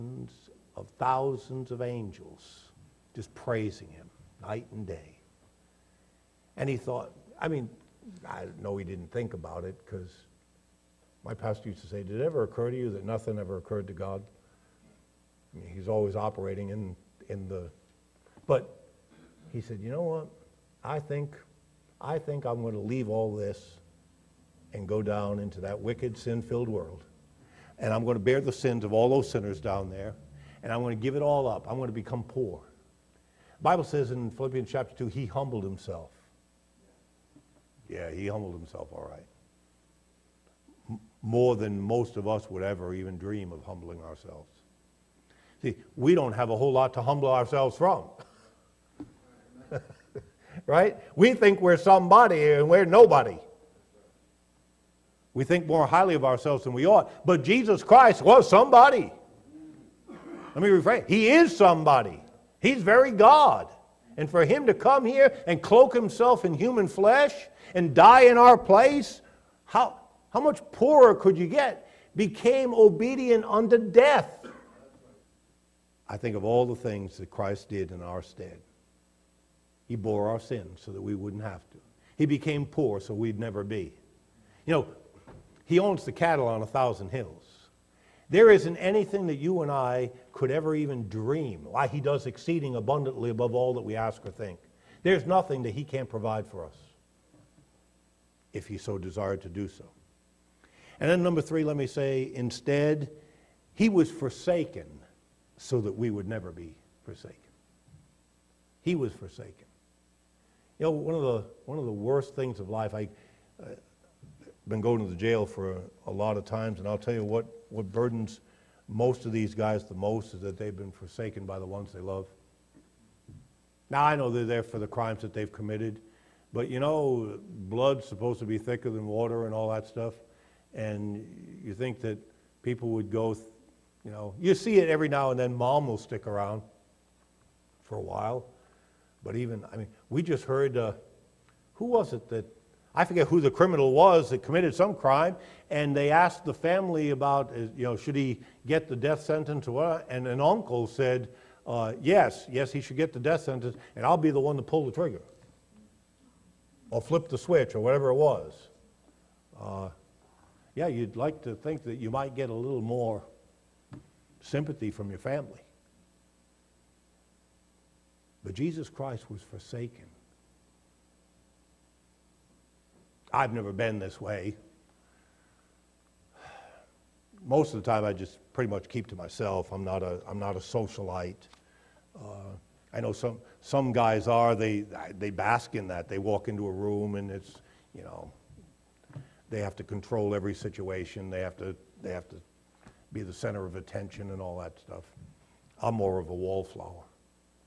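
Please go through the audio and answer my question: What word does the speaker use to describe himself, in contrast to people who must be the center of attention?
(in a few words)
wallflower.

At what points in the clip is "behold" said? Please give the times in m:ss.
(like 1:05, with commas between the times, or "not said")
not said.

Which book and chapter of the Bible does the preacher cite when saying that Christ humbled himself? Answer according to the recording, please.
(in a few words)
Philippians chapter 2.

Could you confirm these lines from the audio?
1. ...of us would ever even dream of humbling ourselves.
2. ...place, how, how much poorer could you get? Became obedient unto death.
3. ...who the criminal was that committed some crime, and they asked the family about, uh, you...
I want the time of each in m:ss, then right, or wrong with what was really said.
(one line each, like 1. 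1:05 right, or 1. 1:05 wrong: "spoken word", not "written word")
1. 0:42 right
2. 1:08 right
3. 2:23 right.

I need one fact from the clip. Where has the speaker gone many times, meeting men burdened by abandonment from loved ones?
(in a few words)
the jail.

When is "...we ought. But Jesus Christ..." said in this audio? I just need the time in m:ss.
0:56.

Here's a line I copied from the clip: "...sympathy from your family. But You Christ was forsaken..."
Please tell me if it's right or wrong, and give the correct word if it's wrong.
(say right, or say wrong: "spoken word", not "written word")
wrong: "Jesus", not "You".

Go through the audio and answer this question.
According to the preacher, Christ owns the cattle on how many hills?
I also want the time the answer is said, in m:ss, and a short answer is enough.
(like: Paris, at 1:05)
1000, at 1:26.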